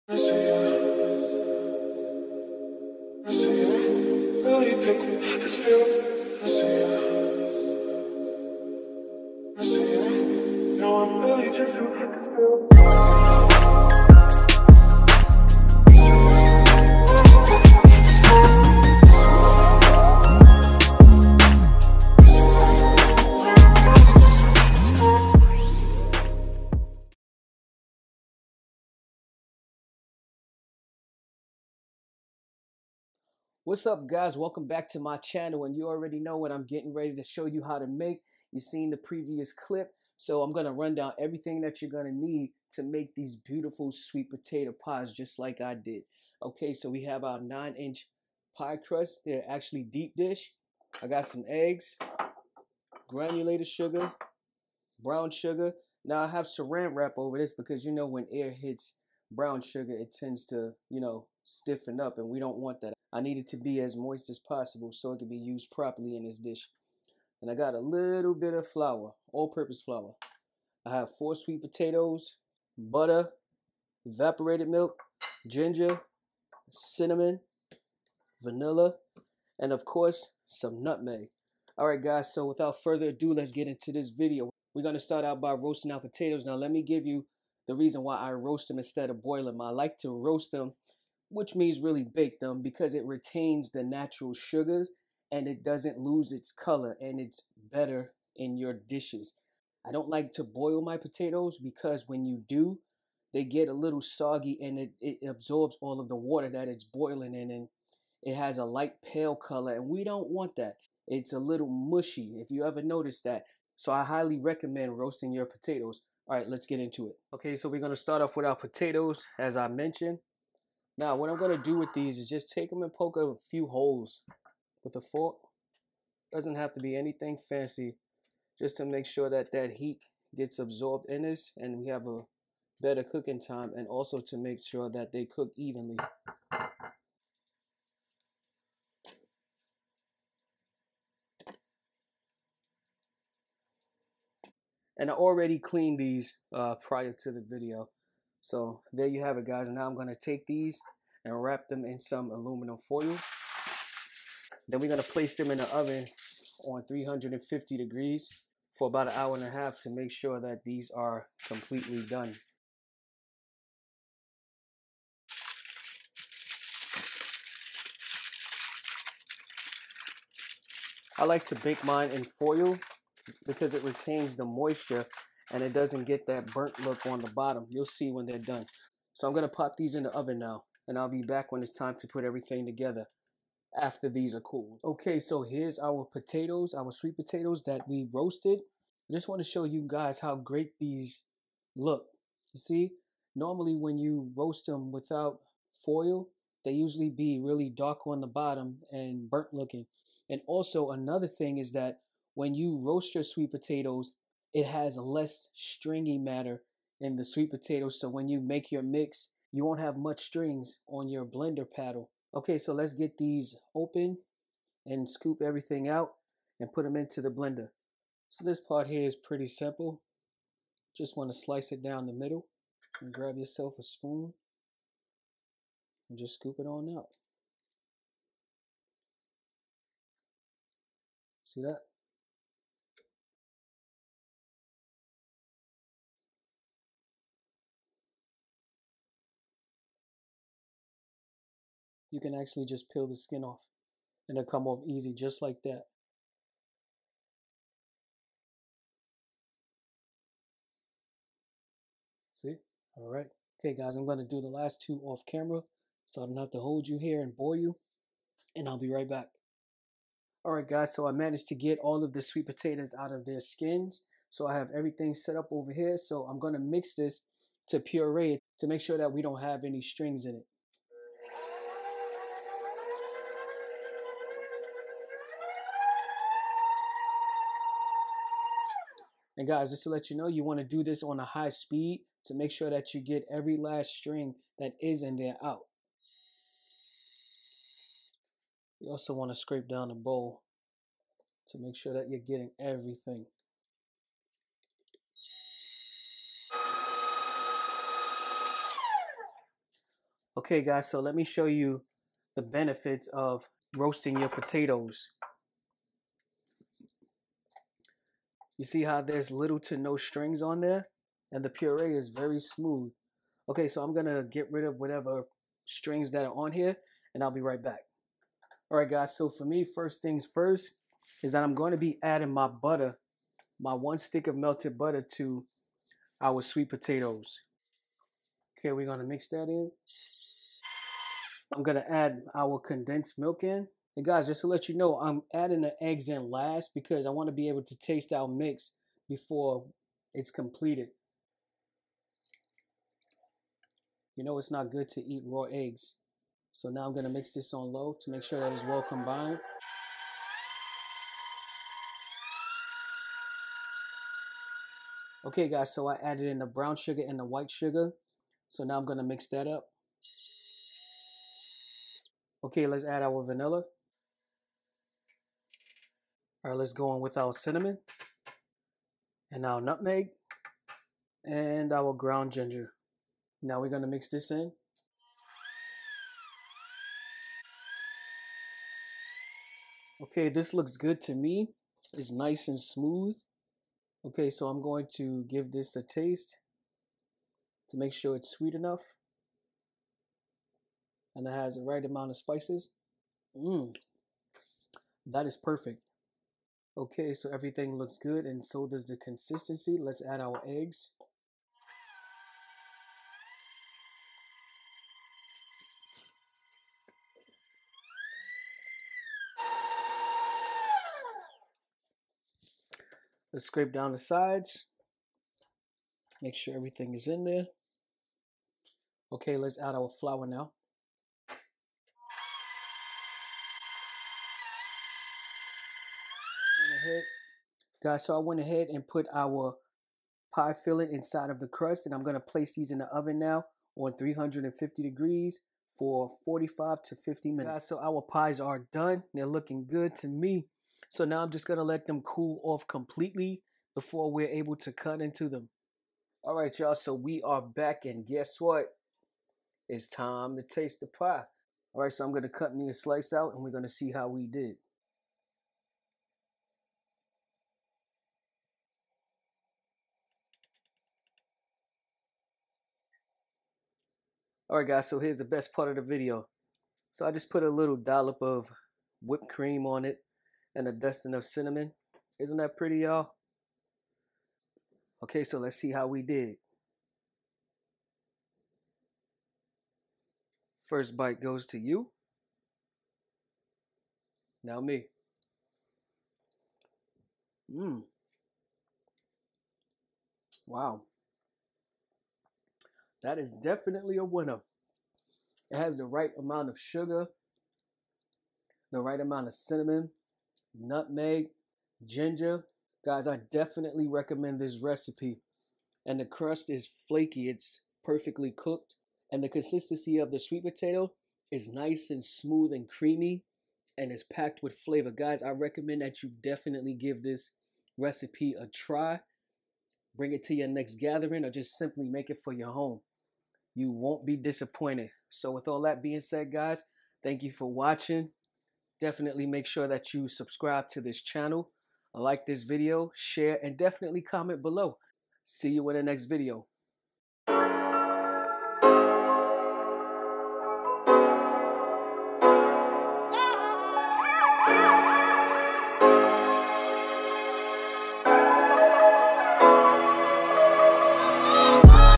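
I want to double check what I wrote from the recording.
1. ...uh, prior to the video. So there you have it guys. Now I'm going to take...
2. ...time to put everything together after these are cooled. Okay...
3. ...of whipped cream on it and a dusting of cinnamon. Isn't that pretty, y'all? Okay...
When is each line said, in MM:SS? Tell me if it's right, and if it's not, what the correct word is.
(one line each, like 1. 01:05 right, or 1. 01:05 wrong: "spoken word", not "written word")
1. 02:26 right
2. 03:01 right
3. 07:48 right.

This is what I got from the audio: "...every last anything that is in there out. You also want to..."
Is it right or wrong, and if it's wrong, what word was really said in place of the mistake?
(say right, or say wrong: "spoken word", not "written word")
wrong: "string", not "anything".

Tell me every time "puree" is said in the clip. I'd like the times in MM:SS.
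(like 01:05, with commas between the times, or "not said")
04:27, 05:11.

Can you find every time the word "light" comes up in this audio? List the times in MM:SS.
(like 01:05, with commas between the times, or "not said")
01:48.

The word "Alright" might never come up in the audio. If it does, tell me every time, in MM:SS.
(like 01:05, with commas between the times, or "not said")
01:21, 07:44.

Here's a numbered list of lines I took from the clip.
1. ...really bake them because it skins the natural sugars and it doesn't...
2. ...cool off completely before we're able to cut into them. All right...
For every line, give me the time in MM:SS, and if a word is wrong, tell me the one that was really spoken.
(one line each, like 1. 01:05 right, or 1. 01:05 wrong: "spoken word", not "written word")
1. 01:31 wrong: "retains", not "skins"
2. 07:22 right.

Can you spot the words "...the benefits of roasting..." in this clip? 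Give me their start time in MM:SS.
05:02.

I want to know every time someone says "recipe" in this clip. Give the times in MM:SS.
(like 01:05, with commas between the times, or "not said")
08:24, 08:37.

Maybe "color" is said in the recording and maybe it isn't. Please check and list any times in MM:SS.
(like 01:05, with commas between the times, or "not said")
01:36, 01:49.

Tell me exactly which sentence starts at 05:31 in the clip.
I'm gonna add our condensed milk in.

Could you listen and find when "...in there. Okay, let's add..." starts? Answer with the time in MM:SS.
06:57.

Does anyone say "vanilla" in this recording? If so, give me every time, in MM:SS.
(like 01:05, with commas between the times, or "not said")
01:18, 06:03.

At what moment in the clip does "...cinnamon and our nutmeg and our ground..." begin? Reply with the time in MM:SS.
06:07.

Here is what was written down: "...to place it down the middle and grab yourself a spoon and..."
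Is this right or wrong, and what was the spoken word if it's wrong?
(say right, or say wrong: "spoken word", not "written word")
wrong: "slice", not "place".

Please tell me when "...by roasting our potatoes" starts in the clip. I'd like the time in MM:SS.
01:25.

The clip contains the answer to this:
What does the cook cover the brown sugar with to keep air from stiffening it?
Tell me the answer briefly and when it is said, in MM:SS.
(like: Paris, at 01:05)
saran wrap, at 00:56.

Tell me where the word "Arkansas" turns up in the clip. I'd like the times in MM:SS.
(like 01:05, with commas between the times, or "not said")
not said.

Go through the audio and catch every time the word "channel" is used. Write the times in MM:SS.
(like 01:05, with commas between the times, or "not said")
00:35, 08:51.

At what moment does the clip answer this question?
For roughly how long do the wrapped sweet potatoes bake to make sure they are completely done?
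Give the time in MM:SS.
02:39.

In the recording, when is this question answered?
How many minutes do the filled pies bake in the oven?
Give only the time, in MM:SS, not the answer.
07:16.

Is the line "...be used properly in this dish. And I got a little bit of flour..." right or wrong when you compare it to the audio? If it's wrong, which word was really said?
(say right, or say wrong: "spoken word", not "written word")
right.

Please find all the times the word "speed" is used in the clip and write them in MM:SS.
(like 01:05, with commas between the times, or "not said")
04:41.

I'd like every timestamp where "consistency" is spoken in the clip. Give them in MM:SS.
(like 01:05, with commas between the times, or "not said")
06:38, 08:29.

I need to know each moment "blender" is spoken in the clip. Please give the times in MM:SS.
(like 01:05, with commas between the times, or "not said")
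03:31, 03:37.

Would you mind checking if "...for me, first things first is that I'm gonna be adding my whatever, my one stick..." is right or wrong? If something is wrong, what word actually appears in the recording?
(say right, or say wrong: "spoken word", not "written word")
wrong: "butter", not "whatever".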